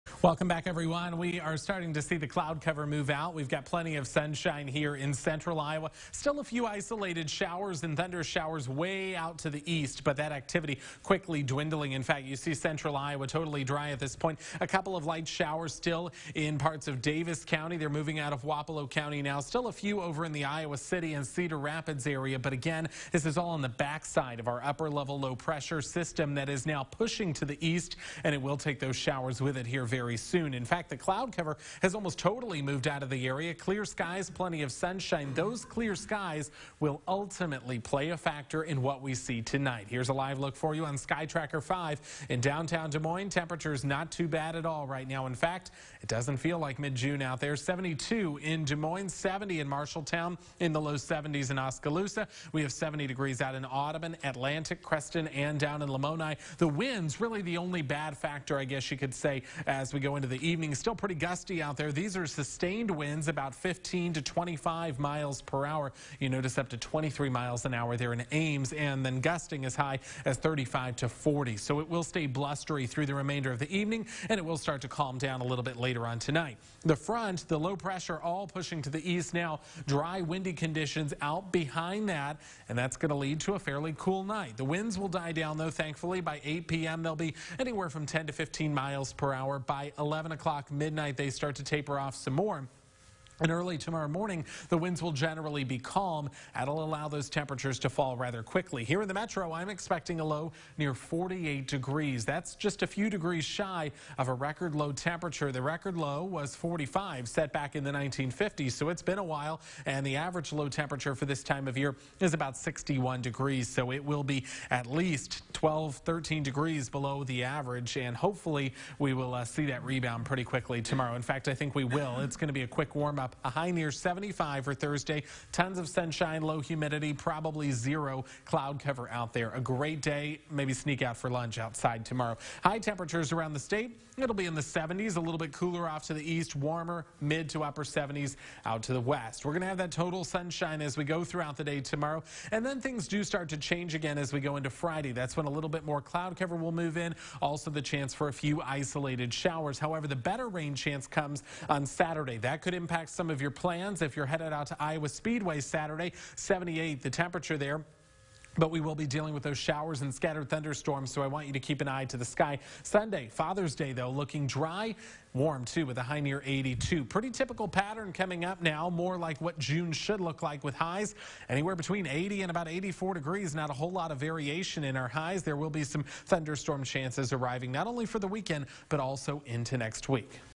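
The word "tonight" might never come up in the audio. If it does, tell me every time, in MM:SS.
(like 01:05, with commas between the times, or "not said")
00:39, 01:16.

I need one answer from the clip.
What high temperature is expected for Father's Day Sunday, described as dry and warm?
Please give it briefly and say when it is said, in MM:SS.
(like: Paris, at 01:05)
82, at 02:46.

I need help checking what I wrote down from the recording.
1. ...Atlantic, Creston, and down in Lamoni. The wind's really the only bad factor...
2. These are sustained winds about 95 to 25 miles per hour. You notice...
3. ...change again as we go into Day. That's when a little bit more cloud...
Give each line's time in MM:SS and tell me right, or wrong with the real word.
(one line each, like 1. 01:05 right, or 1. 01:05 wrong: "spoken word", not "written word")
1. 00:54 right
2. 01:01 wrong: "15", not "95"
3. 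02:23 wrong: "Friday", not "Day".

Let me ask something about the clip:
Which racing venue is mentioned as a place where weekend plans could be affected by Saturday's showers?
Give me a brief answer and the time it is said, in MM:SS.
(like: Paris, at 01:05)
Iowa Speedway, at 02:34.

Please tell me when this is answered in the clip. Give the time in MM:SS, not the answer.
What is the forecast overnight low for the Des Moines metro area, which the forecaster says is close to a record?
01:40.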